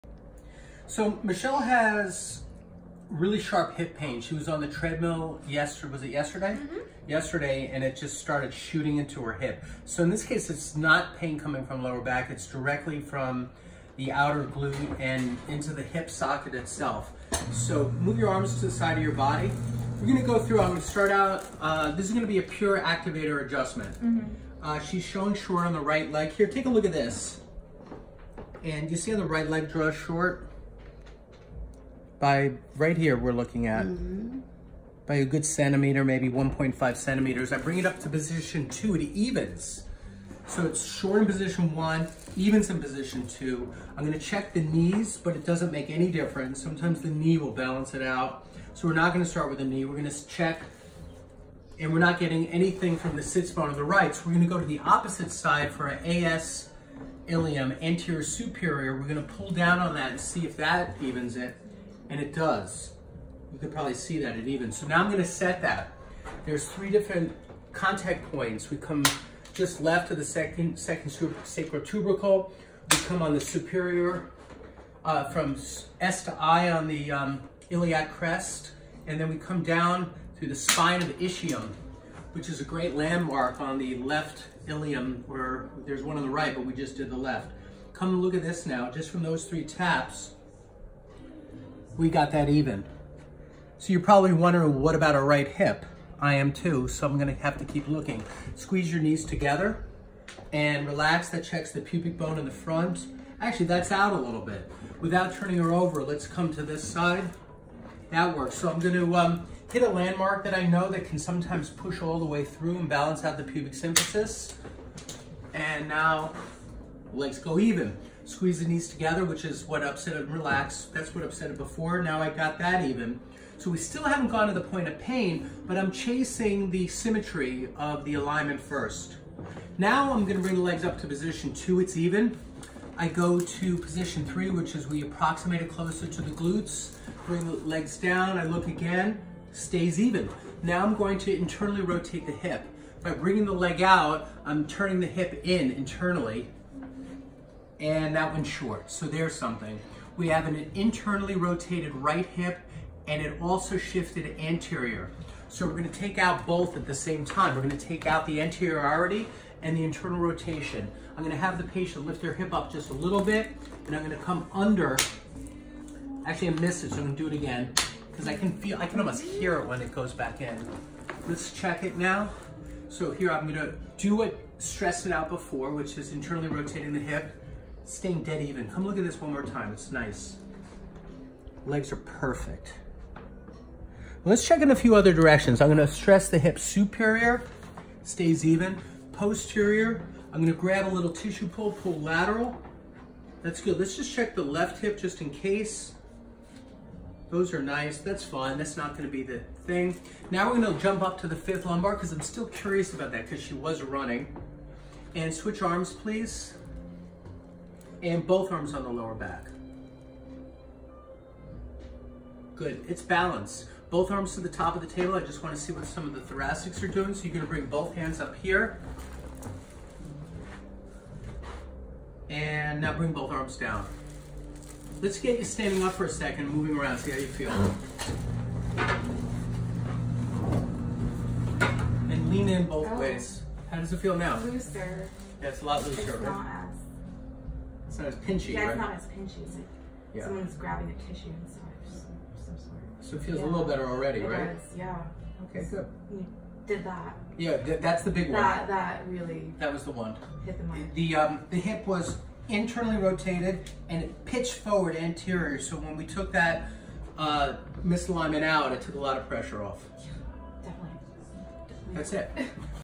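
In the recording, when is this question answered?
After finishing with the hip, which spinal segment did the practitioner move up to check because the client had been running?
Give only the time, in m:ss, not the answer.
3:21.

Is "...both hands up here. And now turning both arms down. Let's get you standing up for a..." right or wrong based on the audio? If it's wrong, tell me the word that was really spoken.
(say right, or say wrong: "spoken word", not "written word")
wrong: "bring", not "turning".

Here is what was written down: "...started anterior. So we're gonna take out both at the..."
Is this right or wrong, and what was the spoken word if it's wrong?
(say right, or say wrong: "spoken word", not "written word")
wrong: "shifted", not "started".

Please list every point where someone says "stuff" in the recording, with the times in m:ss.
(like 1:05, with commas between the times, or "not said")
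4:01.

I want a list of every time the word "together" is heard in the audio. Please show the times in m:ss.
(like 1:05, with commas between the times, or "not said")
1:39, 1:58.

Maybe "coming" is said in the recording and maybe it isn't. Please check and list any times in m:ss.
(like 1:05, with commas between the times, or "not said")
0:11.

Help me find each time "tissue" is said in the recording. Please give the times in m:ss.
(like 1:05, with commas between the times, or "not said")
3:11, 4:01.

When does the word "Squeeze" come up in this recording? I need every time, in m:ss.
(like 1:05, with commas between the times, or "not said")
1:38, 1:58.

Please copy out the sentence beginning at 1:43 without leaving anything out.
Actually, that's out a little bit.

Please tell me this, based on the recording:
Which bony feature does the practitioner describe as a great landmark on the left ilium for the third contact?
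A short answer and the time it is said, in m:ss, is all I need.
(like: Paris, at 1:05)
spine of the ischium, at 1:20.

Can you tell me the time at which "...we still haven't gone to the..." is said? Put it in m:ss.
2:03.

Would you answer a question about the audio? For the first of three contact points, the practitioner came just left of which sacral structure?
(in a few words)
second sacral tubercle.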